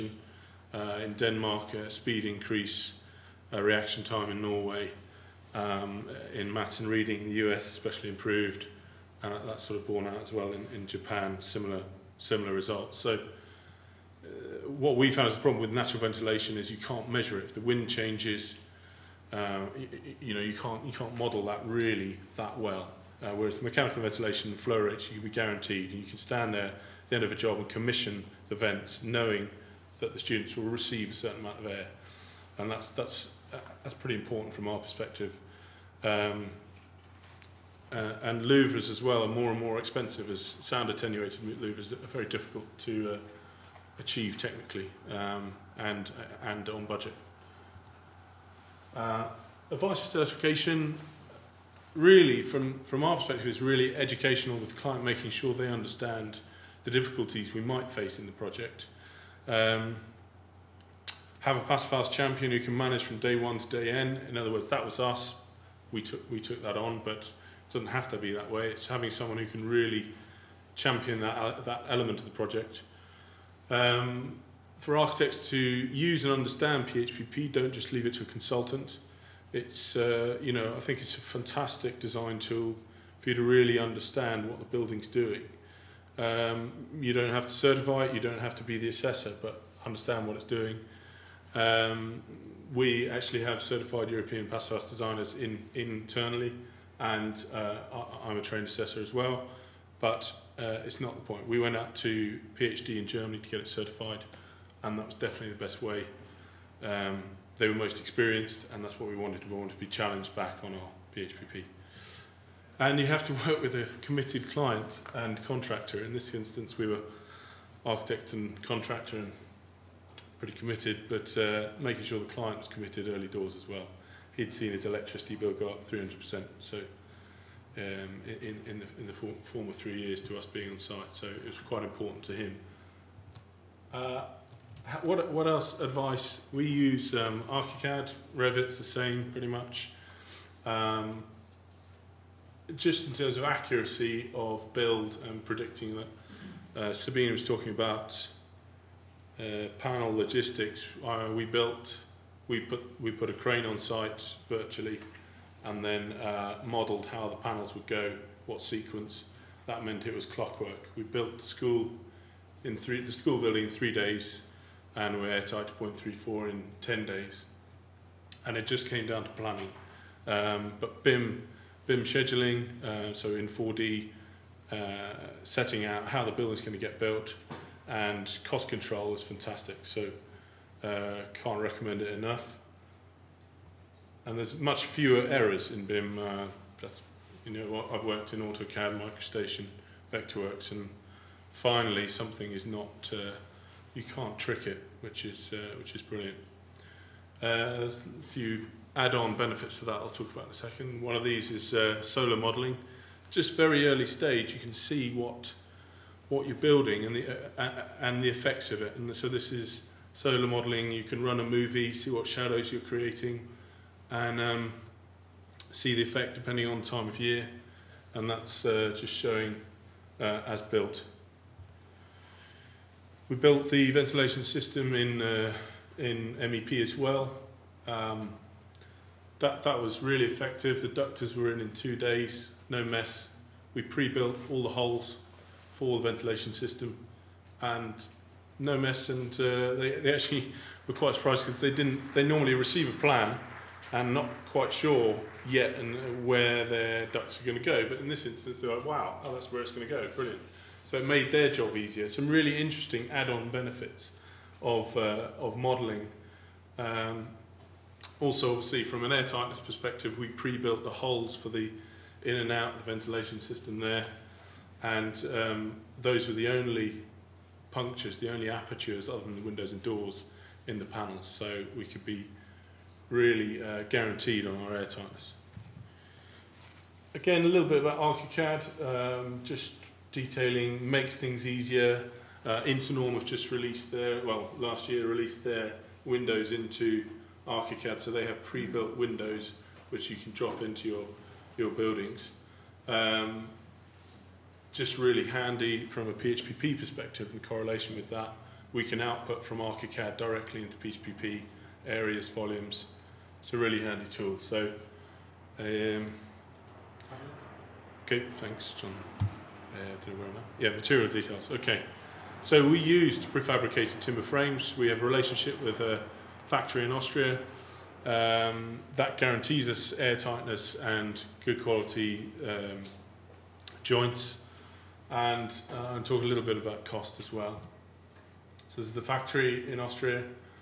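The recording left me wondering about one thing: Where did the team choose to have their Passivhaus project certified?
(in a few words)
PHI in Germany.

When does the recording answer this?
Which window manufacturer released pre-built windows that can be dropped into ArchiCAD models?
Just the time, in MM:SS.
04:42.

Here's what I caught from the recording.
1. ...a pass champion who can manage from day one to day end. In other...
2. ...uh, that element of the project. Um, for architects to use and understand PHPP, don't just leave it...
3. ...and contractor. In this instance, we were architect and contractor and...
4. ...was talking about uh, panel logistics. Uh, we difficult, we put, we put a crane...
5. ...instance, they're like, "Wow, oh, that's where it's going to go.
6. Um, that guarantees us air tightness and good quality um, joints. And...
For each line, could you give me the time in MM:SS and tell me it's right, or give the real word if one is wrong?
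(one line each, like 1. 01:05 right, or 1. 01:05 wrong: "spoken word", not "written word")
1. 01:01 right
2. 01:11 right
3. 01:55 right
4. 02:27 wrong: "built", not "difficult"
5. 04:08 right
6. 05:18 right.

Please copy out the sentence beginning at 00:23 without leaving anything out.
Uh, whereas mechanical ventilation and flow rates, you can be guaranteed.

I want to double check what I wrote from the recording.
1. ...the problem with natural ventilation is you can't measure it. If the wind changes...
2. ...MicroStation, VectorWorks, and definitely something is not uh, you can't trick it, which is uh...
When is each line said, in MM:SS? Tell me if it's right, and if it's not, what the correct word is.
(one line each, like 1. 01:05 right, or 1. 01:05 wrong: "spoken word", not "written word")
1. 00:15 right
2. 03:08 wrong: "finally", not "definitely".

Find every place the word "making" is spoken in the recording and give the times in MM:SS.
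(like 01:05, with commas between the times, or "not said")
00:55, 02:01.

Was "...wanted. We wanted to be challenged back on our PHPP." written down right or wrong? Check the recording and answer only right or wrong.
right.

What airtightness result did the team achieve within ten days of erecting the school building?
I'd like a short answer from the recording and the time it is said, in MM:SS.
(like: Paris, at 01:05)
0.34, at 02:45.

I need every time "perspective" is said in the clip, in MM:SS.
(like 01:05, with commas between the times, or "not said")
00:34, 00:53, 04:19, 04:56.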